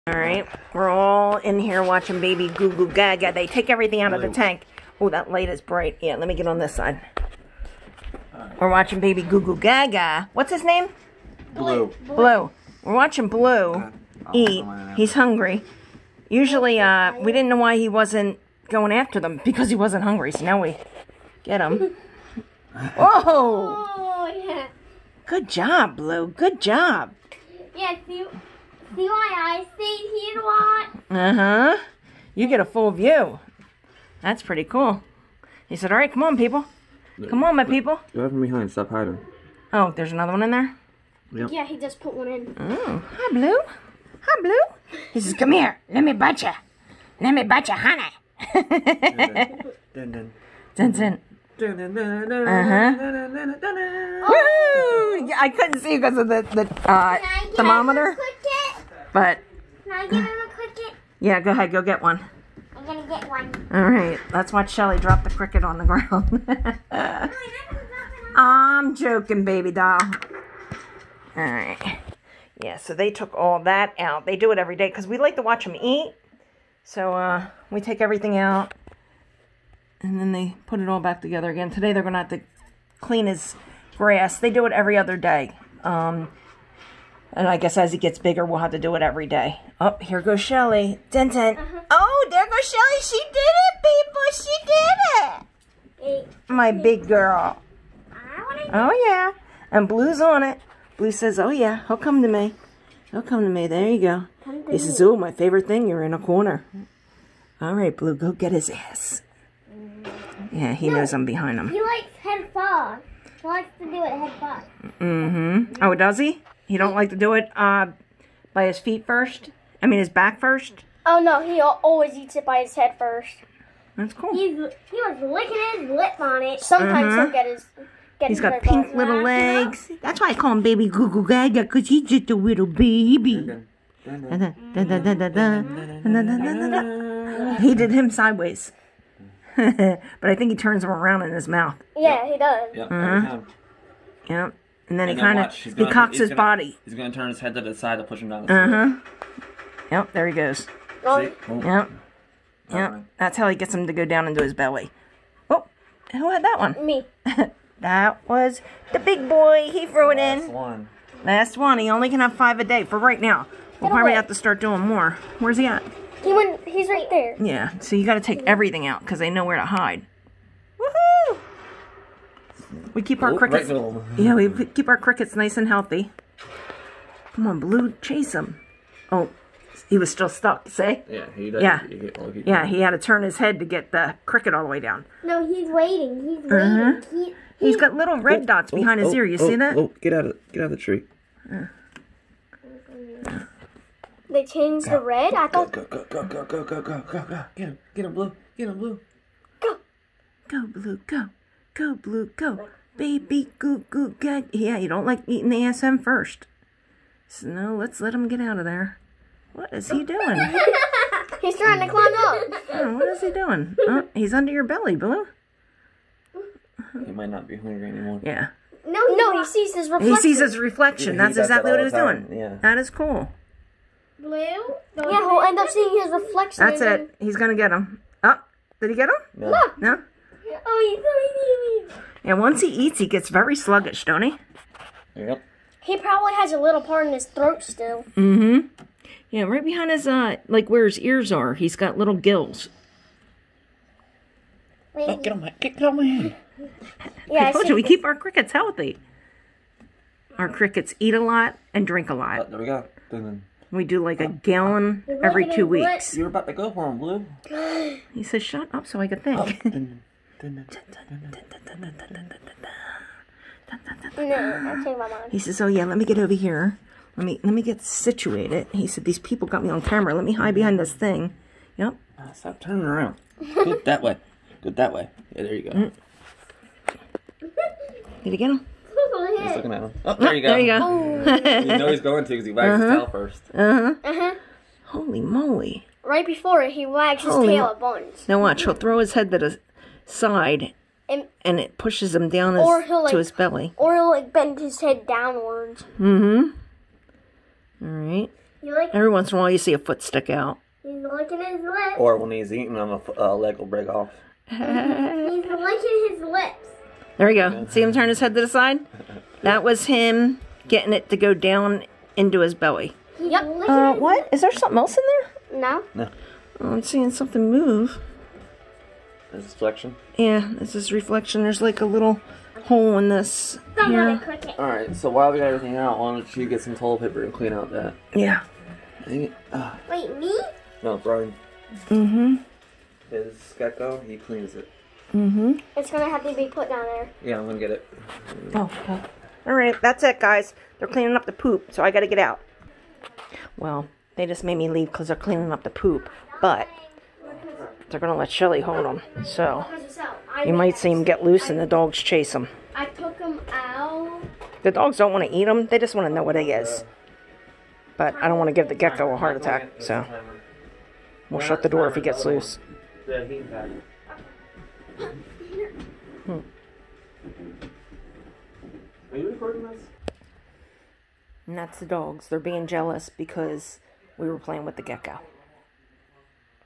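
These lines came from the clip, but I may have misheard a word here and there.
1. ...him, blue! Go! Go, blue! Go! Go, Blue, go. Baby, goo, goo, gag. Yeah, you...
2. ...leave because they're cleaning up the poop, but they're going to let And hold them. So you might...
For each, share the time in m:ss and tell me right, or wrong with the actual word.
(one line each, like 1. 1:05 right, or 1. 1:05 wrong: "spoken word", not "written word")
1. 3:18 right
2. 5:44 wrong: "Shelly", not "And".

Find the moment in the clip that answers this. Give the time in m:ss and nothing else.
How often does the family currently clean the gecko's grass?
1:24.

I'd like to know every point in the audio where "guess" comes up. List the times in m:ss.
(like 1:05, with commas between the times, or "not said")
1:27.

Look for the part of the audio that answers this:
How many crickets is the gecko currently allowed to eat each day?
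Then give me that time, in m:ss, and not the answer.
2:42.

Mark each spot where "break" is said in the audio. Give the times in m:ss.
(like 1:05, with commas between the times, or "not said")
5:03.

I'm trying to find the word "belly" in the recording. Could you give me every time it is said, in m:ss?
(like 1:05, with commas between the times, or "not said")
2:34, 3:34, 4:53, 5:12.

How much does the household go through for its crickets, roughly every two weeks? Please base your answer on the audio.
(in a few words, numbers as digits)
A gallon.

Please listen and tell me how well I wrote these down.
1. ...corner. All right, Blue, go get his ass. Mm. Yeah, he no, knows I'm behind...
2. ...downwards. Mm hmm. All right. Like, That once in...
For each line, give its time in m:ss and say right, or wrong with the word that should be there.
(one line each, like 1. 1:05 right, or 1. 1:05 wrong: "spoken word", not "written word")
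1. 1:46 right
2. 4:55 wrong: "Every", not "That".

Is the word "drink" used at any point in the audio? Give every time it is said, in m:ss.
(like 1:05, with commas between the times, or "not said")
4:11.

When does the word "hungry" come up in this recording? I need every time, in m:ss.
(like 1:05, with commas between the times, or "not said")
0:15, 0:20, 3:37.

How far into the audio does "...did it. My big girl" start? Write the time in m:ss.
1:36.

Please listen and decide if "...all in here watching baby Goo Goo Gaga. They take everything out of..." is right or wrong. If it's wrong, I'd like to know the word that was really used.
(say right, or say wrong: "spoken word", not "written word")
right.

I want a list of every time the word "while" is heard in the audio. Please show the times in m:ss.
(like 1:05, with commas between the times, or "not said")
4:59, 5:25.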